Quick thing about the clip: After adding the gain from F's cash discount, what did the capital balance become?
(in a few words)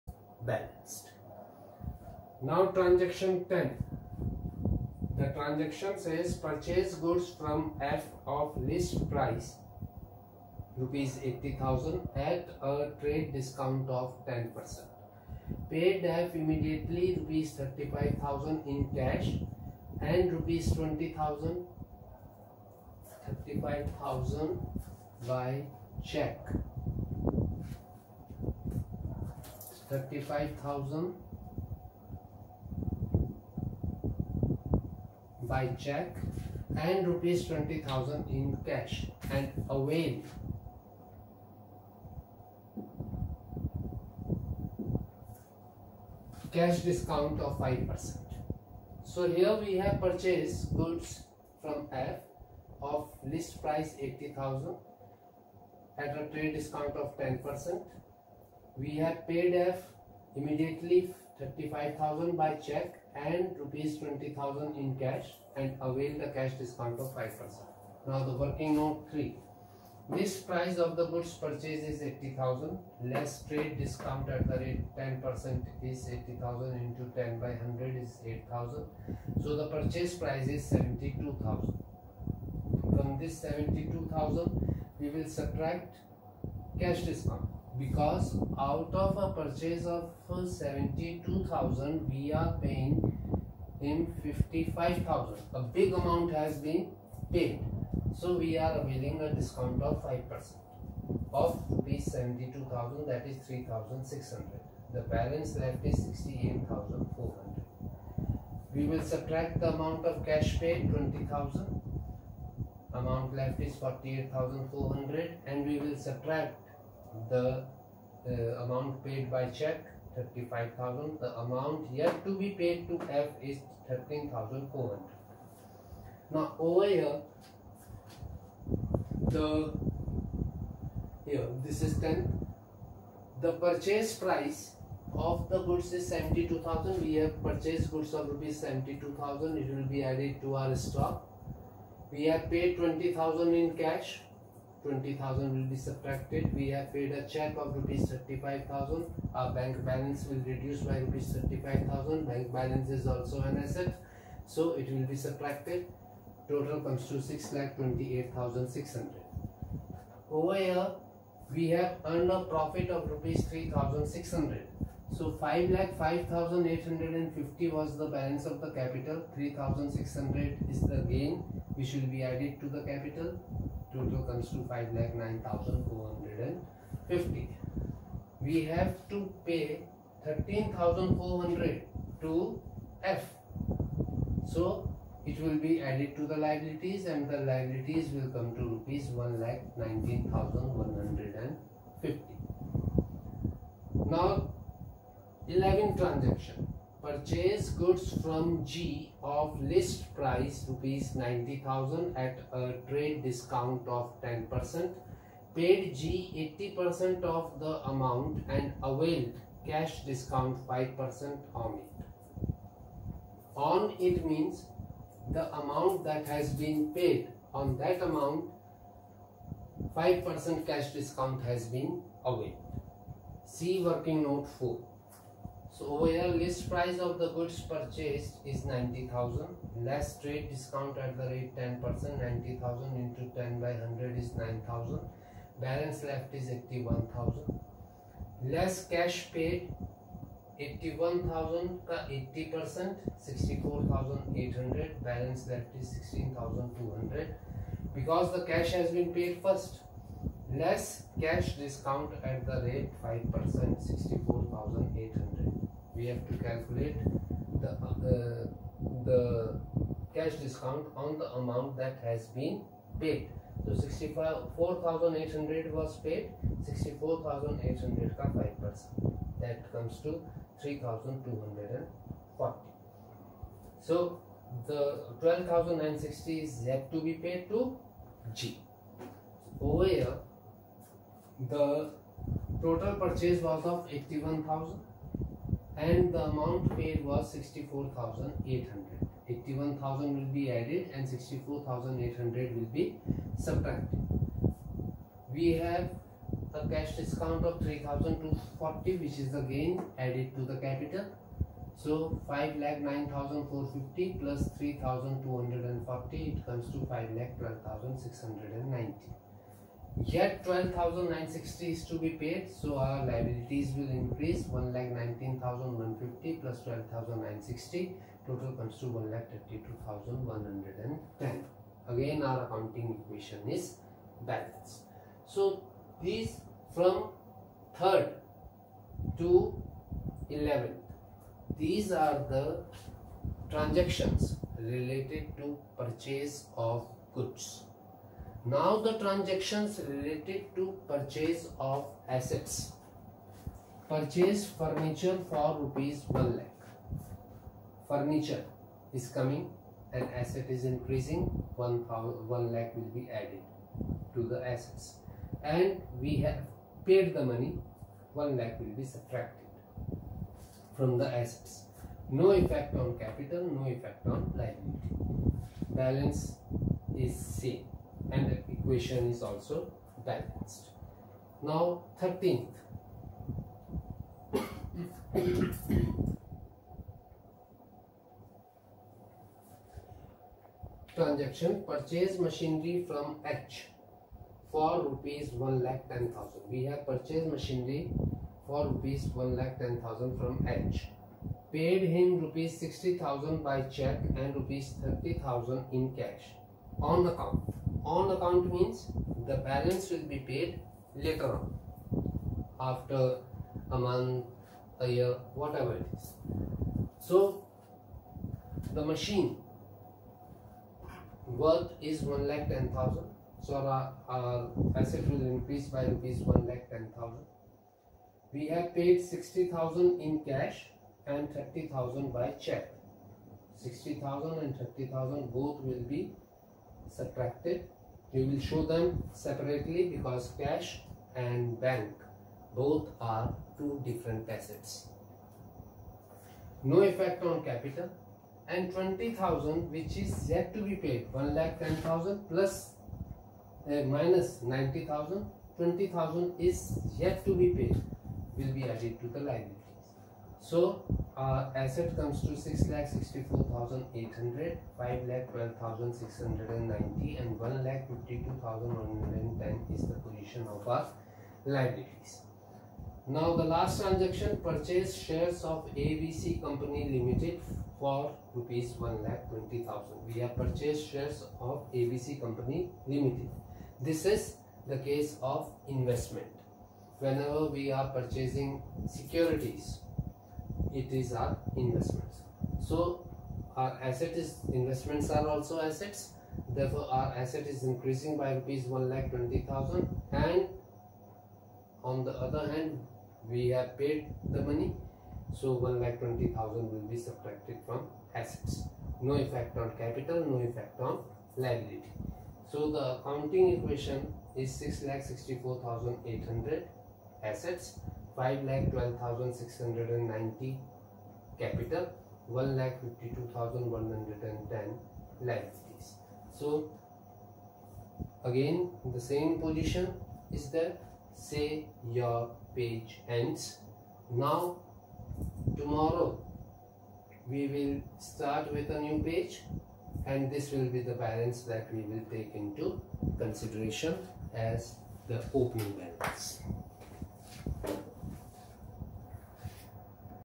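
5,09,450.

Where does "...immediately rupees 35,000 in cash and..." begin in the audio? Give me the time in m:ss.
0:16.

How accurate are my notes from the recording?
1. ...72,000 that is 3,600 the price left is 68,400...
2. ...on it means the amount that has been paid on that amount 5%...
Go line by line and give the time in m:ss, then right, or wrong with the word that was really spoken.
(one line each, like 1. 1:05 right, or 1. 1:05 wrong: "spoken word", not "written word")
1. 1:42 wrong: "balance", not "price"
2. 3:33 right.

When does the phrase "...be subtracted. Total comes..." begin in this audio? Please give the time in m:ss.
2:35.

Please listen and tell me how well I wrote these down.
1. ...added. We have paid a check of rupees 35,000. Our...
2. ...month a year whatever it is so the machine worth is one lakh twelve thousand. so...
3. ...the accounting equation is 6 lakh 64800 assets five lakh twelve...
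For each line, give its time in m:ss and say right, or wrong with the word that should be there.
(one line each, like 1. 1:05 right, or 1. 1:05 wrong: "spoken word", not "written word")
1. 2:25 wrong: "subtracted", not "added"
2. 6:43 wrong: "ten", not "twelve"
3. 8:22 right.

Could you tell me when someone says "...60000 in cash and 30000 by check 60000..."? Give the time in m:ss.
6:59.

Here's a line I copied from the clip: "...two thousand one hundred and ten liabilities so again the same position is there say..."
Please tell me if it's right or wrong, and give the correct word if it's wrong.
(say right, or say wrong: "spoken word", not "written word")
right.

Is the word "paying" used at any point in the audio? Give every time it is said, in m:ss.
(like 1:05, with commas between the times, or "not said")
1:32.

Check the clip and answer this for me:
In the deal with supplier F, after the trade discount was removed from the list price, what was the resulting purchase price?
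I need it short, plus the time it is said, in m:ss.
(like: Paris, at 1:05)
72,000, at 1:19.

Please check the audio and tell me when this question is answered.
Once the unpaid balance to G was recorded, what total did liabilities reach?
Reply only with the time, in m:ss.
5:18.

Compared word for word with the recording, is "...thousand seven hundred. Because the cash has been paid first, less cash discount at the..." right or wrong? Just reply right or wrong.
wrong.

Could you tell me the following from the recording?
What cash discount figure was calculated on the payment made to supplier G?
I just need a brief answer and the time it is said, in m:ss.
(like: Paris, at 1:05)
3,240, at 4:30.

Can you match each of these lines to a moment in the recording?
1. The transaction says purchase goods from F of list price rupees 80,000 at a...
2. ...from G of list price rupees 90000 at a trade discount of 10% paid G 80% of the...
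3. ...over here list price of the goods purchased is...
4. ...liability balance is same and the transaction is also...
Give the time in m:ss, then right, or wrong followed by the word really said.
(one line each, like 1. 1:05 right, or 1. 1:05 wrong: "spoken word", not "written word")
1. 0:05 right
2. 3:18 right
3. 3:45 right
4. 6:04 wrong: "equation", not "transaction".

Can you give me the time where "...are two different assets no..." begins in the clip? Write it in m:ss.
7:12.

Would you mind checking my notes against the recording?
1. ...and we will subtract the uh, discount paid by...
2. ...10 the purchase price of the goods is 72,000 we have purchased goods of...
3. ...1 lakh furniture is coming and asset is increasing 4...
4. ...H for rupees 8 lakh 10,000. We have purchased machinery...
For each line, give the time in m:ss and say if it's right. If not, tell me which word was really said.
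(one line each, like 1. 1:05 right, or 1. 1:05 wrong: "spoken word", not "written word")
1. 1:55 wrong: "amount", not "discount"
2. 2:11 right
3. 5:46 wrong: "1", not "4"
4. 6:23 wrong: "1", not "8".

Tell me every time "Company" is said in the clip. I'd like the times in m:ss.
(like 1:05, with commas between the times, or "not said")
7:46, 7:52.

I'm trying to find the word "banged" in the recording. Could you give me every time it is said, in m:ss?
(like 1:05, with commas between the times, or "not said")
not said.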